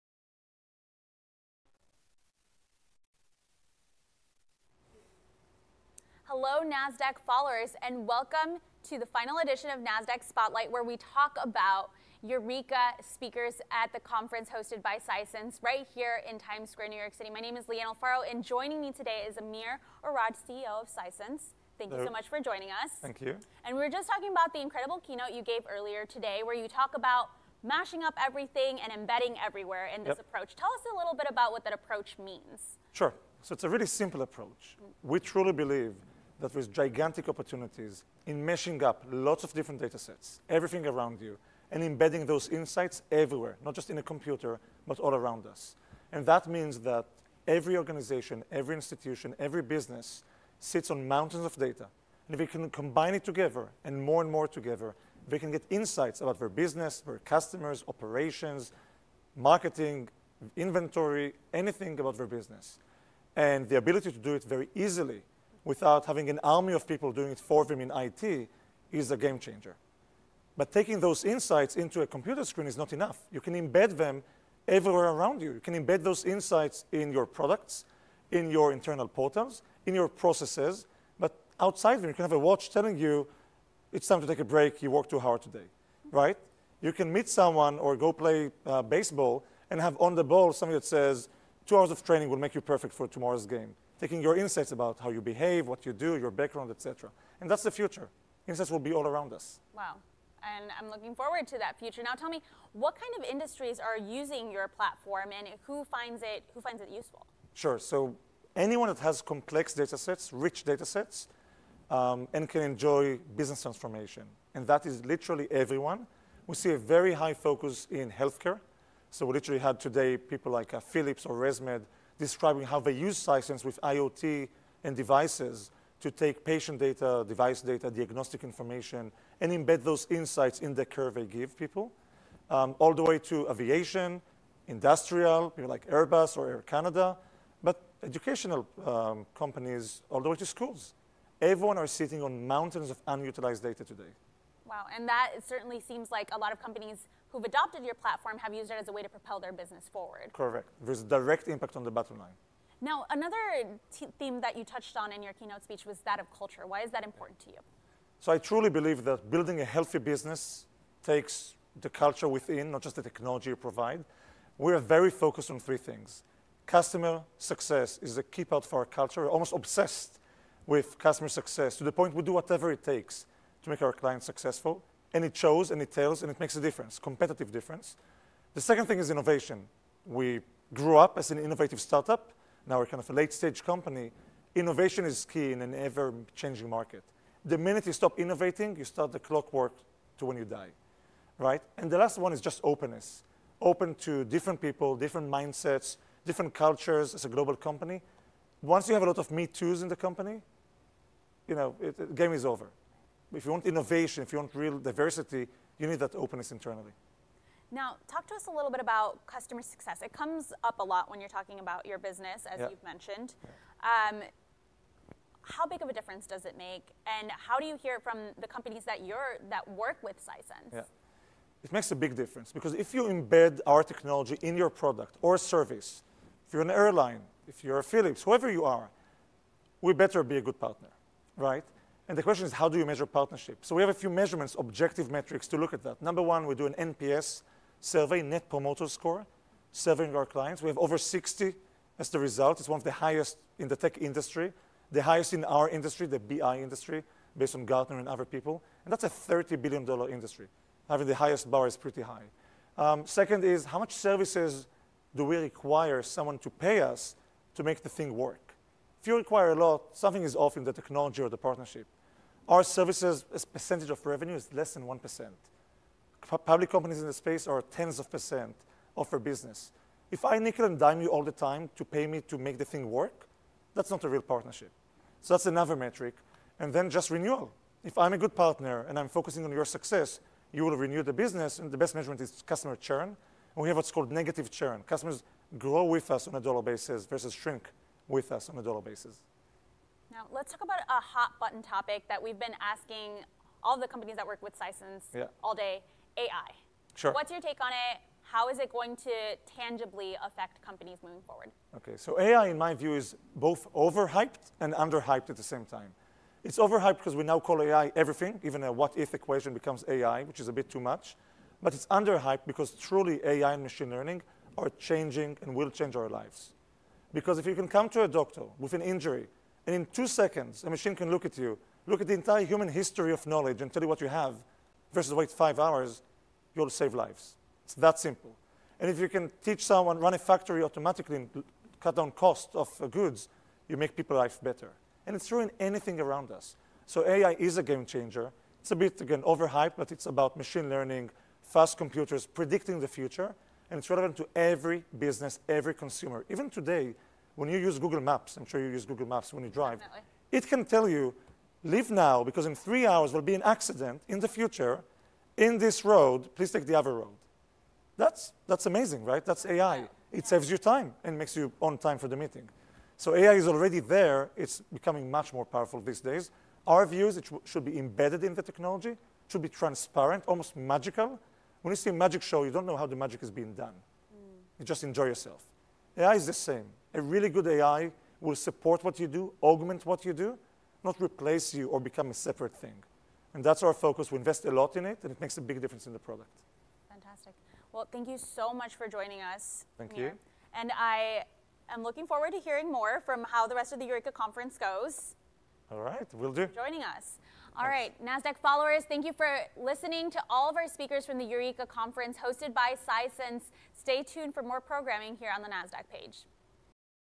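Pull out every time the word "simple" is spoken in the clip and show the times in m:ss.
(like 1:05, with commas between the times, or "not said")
0:33, 5:27.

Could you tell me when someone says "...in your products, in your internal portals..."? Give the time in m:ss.
1:16.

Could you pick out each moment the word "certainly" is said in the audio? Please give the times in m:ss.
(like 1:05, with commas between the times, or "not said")
2:25.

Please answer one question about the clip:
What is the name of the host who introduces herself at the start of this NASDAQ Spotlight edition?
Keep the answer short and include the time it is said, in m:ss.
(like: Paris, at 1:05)
Leanne Alfaro, at 0:17.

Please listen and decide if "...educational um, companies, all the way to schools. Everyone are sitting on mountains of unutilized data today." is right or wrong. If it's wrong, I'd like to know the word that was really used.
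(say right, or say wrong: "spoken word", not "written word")
right.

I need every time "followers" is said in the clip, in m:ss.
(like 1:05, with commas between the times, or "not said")
0:07, 6:38.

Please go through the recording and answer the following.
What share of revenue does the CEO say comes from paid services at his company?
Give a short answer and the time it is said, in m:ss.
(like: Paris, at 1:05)
less than 1%, at 4:24.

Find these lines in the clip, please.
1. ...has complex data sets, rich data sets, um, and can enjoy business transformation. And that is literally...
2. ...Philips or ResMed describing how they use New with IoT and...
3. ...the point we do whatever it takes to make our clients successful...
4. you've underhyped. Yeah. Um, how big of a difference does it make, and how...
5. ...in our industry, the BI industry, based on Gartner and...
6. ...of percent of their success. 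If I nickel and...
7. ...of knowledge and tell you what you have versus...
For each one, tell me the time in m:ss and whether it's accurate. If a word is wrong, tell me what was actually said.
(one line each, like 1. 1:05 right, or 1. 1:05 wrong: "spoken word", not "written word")
1. 1:48 right
2. 2:00 wrong: "Sisense", not "New"
3. 2:51 right
4. 3:32 wrong: "mentioned", not "underhyped"
5. 4:05 right
6. 4:27 wrong: "business", not "success"
7. 5:23 right.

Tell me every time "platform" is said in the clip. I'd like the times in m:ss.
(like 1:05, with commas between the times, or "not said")
1:44, 2:27.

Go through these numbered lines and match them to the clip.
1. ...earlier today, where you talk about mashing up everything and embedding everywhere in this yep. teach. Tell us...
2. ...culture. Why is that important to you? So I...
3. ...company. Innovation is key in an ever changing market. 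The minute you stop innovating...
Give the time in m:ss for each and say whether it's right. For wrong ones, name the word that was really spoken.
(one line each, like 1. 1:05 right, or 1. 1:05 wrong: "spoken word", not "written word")
1. 0:25 wrong: "approach", not "teach"
2. 2:36 right
3. 3:03 right.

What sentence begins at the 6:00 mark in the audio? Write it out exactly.
saves you time and makes you on time for the meeting.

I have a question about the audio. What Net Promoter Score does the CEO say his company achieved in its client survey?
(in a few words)
over 60.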